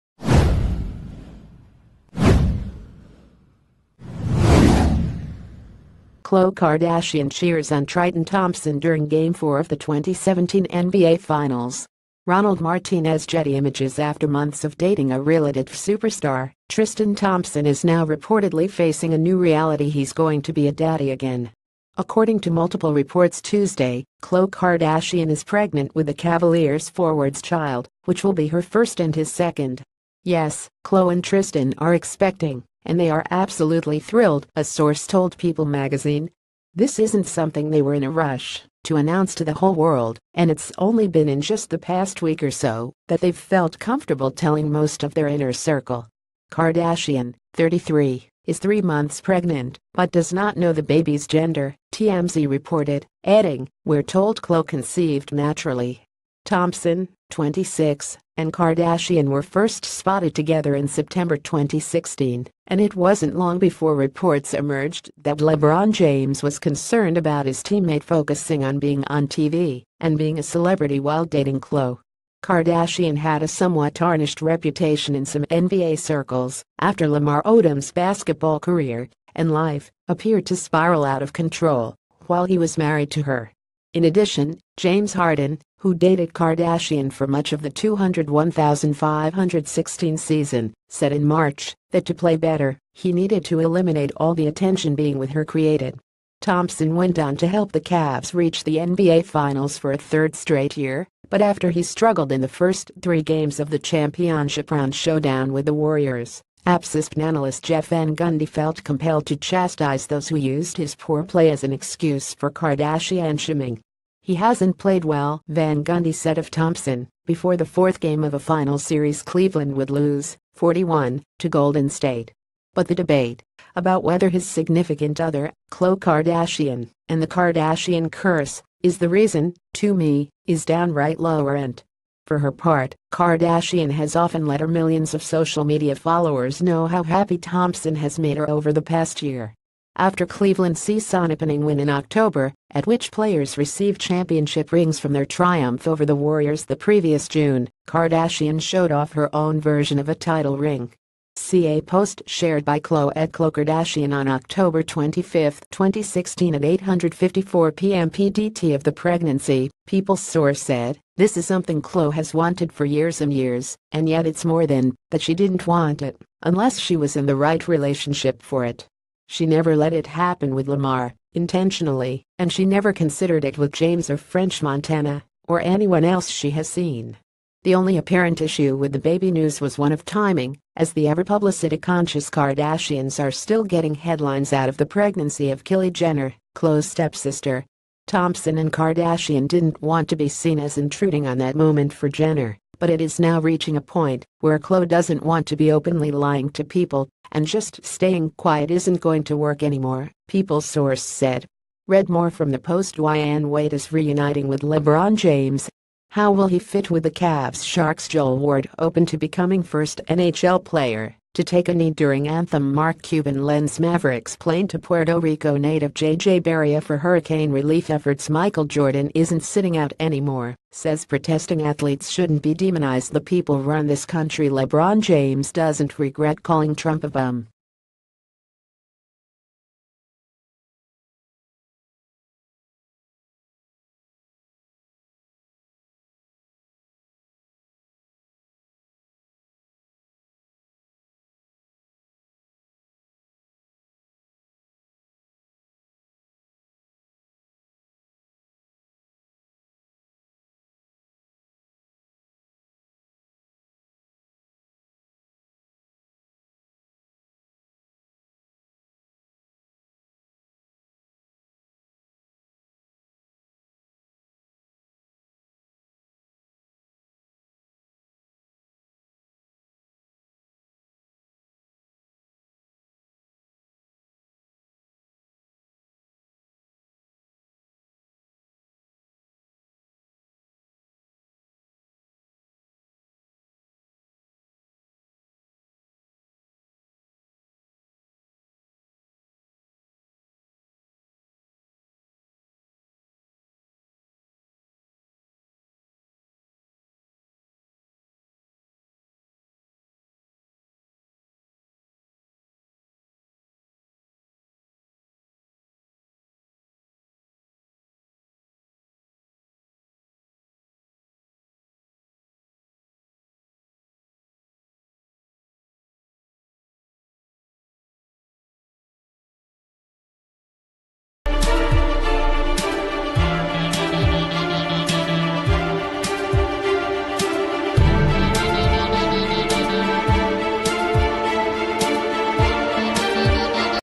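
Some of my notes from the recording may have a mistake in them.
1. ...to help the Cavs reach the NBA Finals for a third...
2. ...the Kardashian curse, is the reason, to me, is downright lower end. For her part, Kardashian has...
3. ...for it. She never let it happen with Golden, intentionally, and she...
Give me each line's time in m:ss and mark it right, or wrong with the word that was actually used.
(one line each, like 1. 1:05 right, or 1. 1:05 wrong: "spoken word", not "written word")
1. 1:37 right
2. 2:07 right
3. 2:48 wrong: "Lamar", not "Golden".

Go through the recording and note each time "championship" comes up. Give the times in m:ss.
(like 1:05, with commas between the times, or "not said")
1:43, 2:23.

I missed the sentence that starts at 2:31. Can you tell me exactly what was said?
See a post shared by Khloe Khloe Kardashian on October 25, 2016 at 8.54 p.m.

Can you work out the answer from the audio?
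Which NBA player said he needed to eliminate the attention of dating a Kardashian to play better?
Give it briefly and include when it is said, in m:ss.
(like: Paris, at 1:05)
James Harden, at 1:24.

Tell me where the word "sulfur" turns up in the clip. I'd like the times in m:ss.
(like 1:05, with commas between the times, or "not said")
not said.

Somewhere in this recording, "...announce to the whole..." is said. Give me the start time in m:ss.
0:38.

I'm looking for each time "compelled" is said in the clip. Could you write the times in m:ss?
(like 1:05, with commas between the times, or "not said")
1:48.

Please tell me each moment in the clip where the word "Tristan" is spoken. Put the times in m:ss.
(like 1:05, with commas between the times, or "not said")
0:16, 0:31.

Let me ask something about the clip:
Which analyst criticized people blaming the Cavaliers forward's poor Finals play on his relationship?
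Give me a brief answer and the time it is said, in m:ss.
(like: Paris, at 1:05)
Jeff Van Gundy, at 1:47.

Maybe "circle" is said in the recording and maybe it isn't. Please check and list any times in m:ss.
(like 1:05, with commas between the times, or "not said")
0:45, 1:15.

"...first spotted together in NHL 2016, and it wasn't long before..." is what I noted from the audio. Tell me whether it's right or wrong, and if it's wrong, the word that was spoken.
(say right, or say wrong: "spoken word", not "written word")
wrong: "September", not "NHL".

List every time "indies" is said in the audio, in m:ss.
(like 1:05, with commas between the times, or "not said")
not said.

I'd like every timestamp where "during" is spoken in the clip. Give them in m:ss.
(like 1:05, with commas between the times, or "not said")
0:08, 3:31.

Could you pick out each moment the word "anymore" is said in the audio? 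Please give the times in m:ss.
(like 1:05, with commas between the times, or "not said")
3:19, 3:39.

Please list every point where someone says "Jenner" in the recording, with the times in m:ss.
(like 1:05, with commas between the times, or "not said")
3:05, 3:12.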